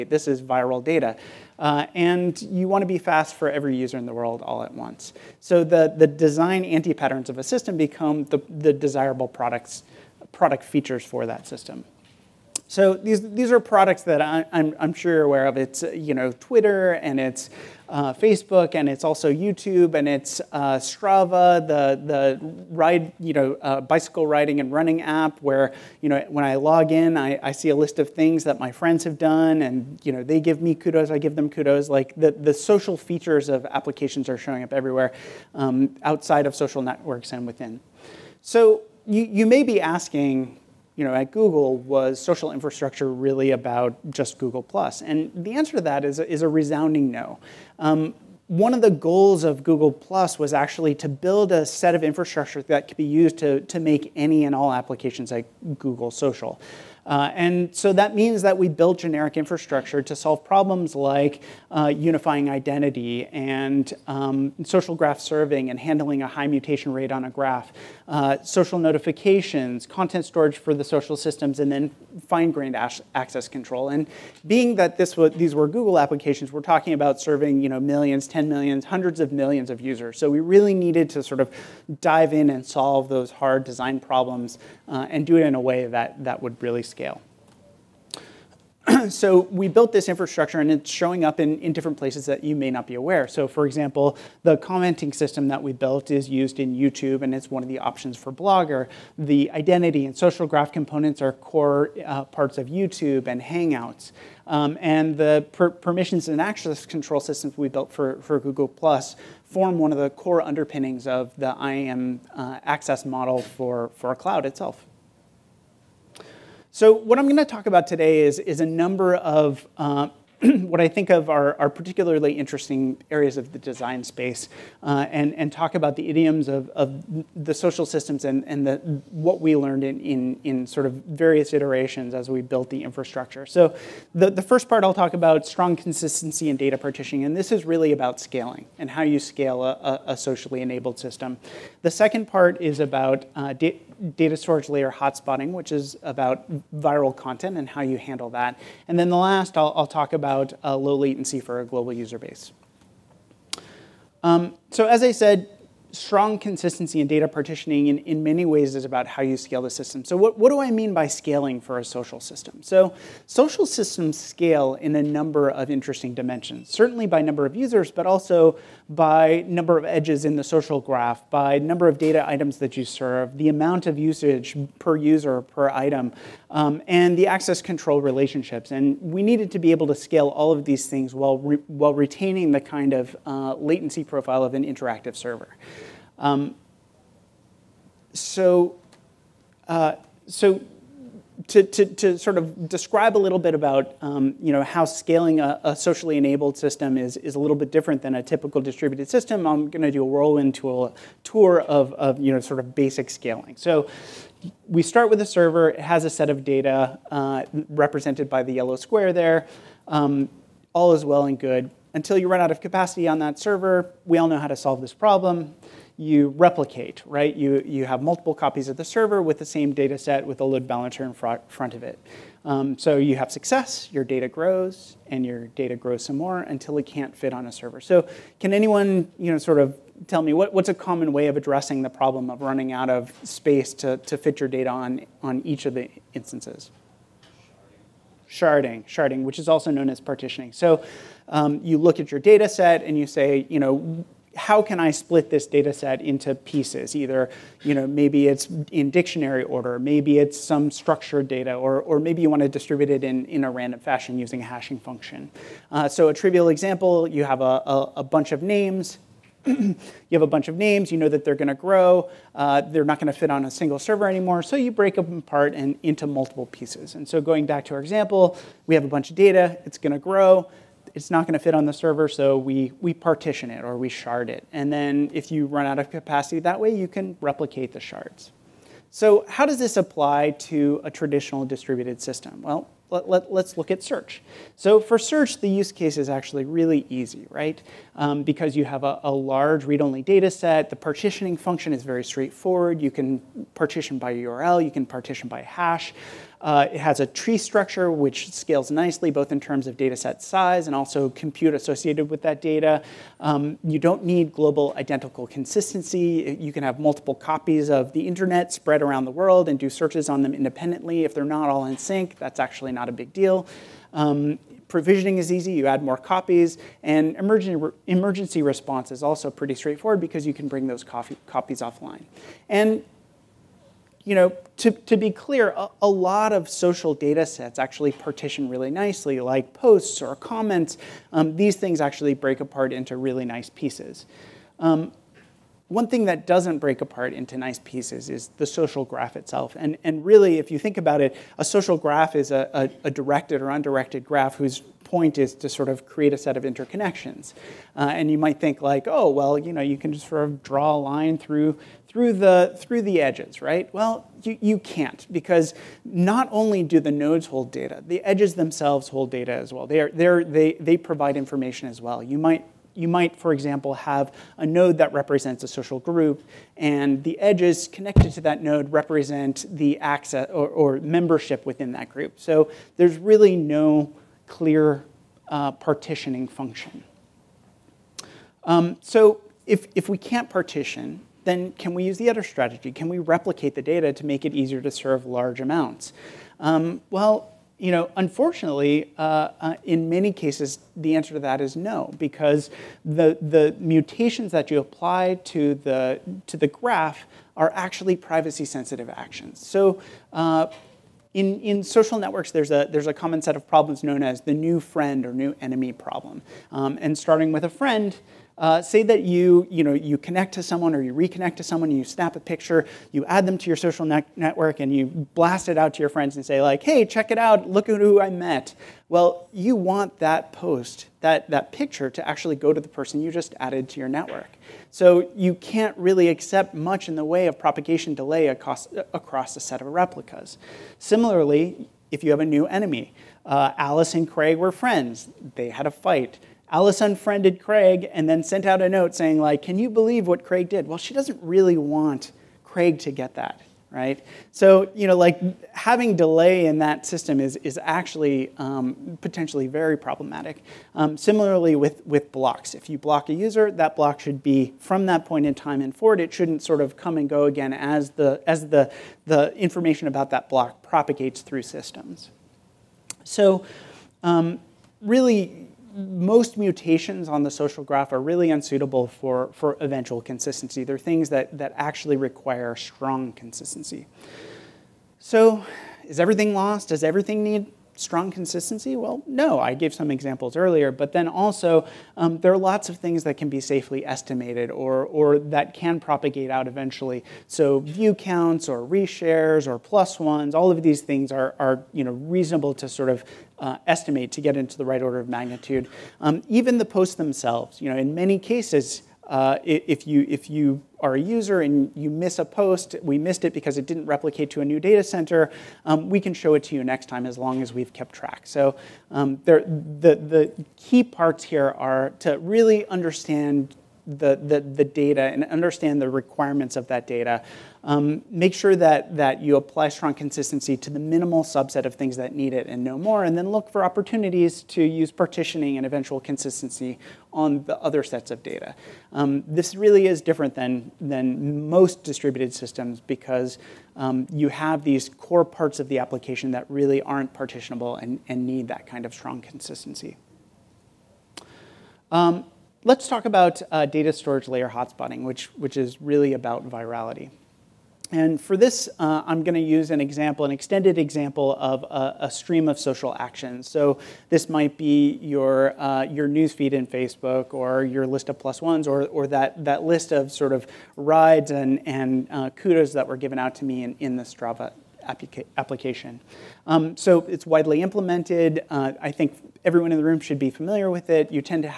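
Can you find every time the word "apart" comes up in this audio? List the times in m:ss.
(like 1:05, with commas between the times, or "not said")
4:25, 5:32, 5:36.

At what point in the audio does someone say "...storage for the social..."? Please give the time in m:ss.
1:10.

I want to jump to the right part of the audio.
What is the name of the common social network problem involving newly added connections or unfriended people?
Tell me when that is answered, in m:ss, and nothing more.
6:44.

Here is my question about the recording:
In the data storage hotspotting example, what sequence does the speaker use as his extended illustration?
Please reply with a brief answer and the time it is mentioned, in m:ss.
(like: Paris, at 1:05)
A stream of social actions, at 9:12.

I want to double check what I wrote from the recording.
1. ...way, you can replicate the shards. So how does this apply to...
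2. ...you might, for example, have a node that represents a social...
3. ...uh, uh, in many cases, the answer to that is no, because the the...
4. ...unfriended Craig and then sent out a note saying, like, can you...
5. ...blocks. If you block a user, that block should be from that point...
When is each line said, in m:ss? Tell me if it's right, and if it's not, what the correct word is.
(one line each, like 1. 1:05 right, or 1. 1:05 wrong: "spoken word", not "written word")
1. 4:36 right
2. 6:02 right
3. 6:28 right
4. 7:16 right
5. 7:32 right.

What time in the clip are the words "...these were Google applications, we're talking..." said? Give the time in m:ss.
1:15.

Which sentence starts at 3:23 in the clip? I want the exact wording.
So we start with a server.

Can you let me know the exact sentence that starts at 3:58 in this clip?
Sharding, sharding, which is also known as partitioning.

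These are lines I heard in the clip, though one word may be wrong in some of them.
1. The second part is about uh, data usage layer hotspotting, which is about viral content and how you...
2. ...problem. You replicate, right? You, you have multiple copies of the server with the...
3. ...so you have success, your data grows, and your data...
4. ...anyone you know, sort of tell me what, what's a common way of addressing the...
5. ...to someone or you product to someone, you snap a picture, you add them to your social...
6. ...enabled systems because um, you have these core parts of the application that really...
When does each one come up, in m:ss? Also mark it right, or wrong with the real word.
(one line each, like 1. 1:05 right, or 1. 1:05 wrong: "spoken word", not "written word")
1. 2:21 wrong: "storage", not "usage"
2. 3:34 right
3. 3:42 right
4. 3:48 right
5. 6:50 wrong: "reconnect", not "product"
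6. 8:51 wrong: "distributed", not "enabled".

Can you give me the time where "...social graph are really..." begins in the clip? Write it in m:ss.
7:47.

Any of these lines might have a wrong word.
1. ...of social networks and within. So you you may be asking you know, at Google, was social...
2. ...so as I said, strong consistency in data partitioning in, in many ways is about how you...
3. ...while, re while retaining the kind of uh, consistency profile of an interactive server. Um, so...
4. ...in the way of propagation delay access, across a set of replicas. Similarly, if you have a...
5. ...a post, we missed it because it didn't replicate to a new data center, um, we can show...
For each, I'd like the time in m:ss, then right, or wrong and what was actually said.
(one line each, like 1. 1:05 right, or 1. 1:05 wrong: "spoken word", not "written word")
1. 0:36 right
2. 2:34 right
3. 3:01 wrong: "latency", not "consistency"
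4. 7:06 wrong: "across", not "access"
5. 8:22 right.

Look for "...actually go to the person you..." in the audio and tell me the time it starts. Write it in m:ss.
7:02.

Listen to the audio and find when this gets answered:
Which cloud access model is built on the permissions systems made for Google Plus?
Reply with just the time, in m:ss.
1:51.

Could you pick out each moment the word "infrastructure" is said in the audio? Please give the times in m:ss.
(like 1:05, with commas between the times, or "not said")
0:42, 0:52, 0:59, 1:30, 2:12.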